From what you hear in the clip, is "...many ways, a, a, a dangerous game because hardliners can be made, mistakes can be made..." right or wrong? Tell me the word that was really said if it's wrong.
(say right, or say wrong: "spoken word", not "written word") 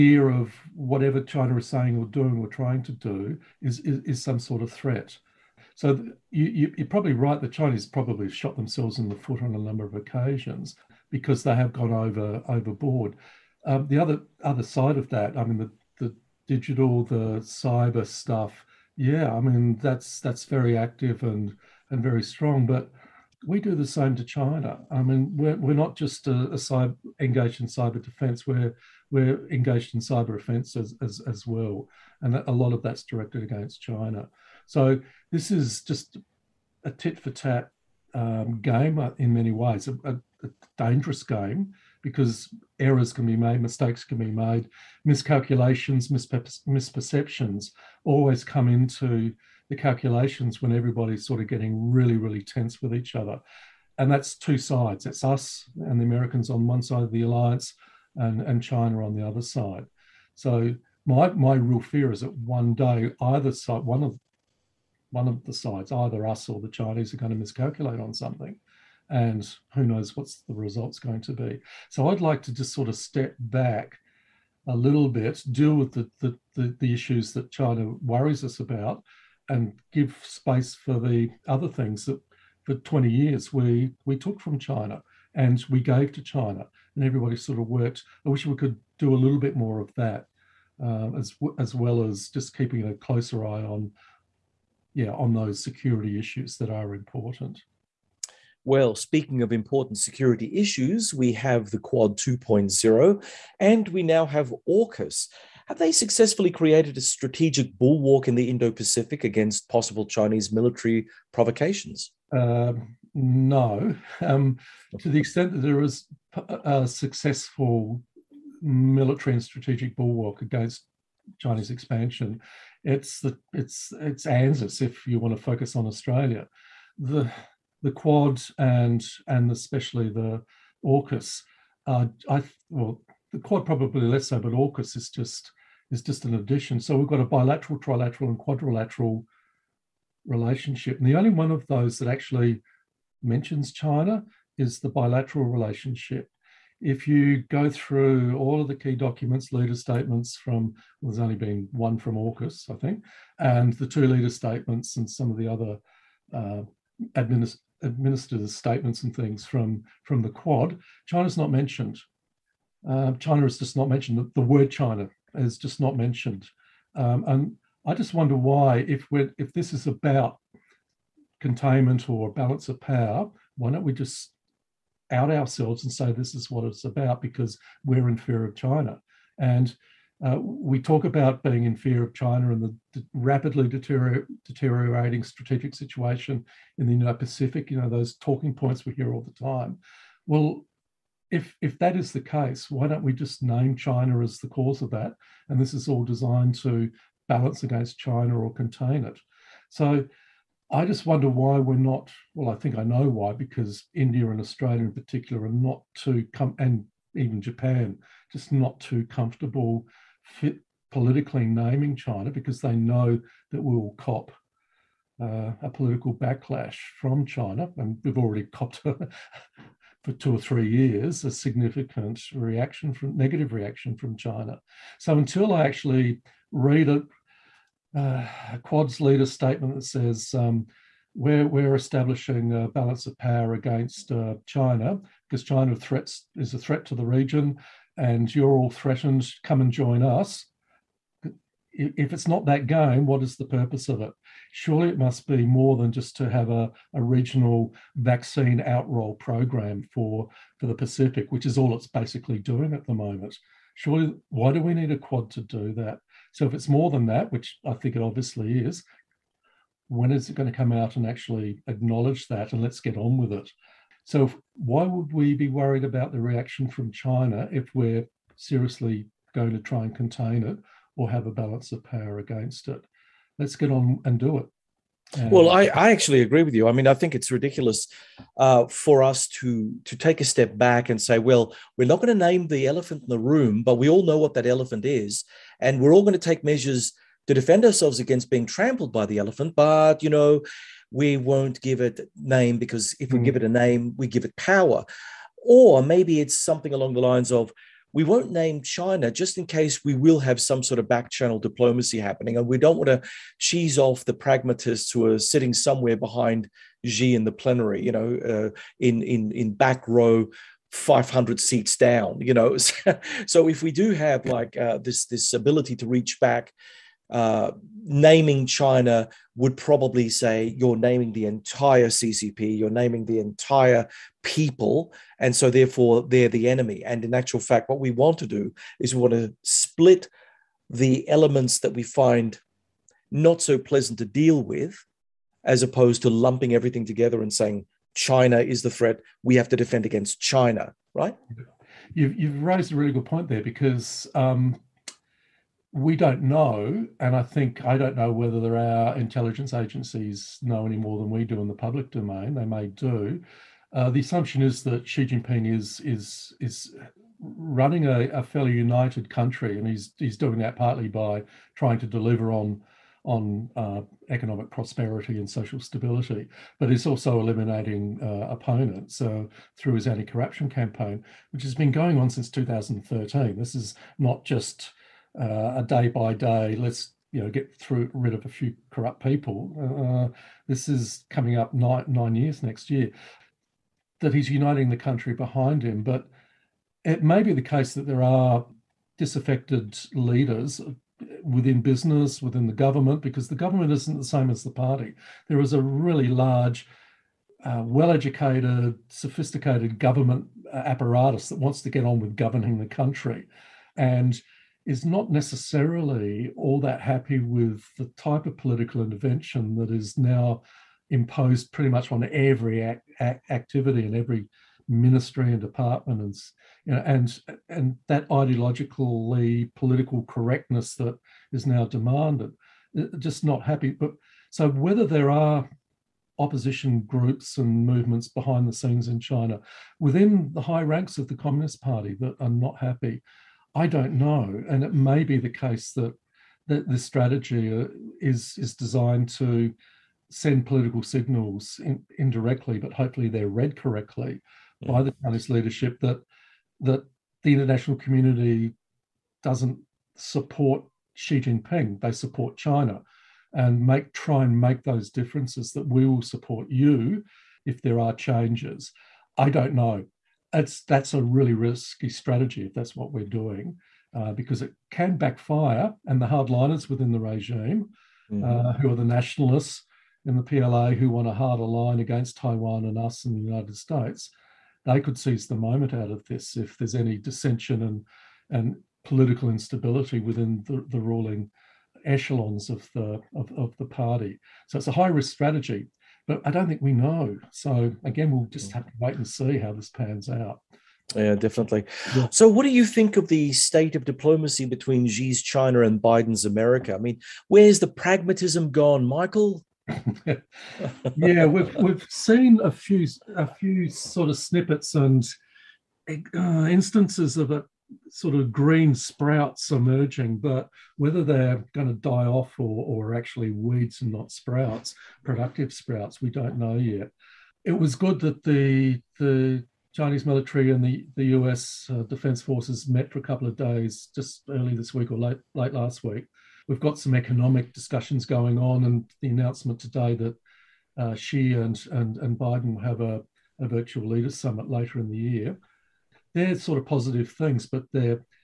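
wrong: "errors", not "hardliners".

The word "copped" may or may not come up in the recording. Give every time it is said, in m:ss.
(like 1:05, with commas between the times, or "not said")
3:38.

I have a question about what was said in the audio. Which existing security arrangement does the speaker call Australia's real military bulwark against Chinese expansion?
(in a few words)
ANZUS.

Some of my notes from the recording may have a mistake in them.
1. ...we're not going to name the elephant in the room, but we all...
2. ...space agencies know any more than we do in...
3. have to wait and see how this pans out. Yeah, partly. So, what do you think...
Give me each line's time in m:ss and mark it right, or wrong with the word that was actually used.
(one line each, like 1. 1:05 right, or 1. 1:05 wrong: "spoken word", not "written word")
1. 4:41 right
2. 5:48 wrong: "intelligence", not "space"
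3. 8:08 wrong: "definitely", not "partly".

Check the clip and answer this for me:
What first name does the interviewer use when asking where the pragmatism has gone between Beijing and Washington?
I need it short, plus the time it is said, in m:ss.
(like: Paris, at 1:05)
Michael, at 8:18.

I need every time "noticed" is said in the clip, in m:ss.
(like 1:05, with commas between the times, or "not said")
not said.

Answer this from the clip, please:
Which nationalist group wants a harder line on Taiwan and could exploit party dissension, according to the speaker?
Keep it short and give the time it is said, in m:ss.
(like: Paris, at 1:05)
the PLA, at 7:50.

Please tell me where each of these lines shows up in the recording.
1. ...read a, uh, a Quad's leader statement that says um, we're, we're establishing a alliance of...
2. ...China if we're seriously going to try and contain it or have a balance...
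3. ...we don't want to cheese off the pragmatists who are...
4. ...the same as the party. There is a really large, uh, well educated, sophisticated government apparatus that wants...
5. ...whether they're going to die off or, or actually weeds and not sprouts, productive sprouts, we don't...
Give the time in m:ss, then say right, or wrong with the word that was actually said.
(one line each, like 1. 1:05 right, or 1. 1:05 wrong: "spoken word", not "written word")
1. 3:46 wrong: "balance", not "alliance"
2. 4:26 right
3. 5:02 right
4. 6:33 right
5. 8:30 right.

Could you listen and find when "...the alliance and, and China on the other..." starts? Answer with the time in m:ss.
0:57.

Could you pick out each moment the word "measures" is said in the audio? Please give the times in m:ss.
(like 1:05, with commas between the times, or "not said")
4:46.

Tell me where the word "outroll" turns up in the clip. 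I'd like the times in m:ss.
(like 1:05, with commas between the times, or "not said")
4:08.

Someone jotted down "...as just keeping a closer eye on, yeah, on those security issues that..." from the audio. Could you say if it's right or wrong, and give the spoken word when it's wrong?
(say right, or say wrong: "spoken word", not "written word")
right.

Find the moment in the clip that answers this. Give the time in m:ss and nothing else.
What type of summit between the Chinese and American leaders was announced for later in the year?
8:53.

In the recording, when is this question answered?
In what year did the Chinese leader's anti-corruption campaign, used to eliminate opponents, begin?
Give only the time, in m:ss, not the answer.
6:12.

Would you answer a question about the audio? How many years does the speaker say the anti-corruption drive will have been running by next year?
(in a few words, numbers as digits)
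9.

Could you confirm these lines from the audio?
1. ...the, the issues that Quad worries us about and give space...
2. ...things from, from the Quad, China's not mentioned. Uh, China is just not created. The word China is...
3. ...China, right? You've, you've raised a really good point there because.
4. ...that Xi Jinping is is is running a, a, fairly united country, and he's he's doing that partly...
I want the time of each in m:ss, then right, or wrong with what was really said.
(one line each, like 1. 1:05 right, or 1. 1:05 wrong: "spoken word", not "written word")
1. 1:16 wrong: "China", not "Quad"
2. 2:39 wrong: "mentioned", not "created"
3. 5:40 right
4. 5:54 right.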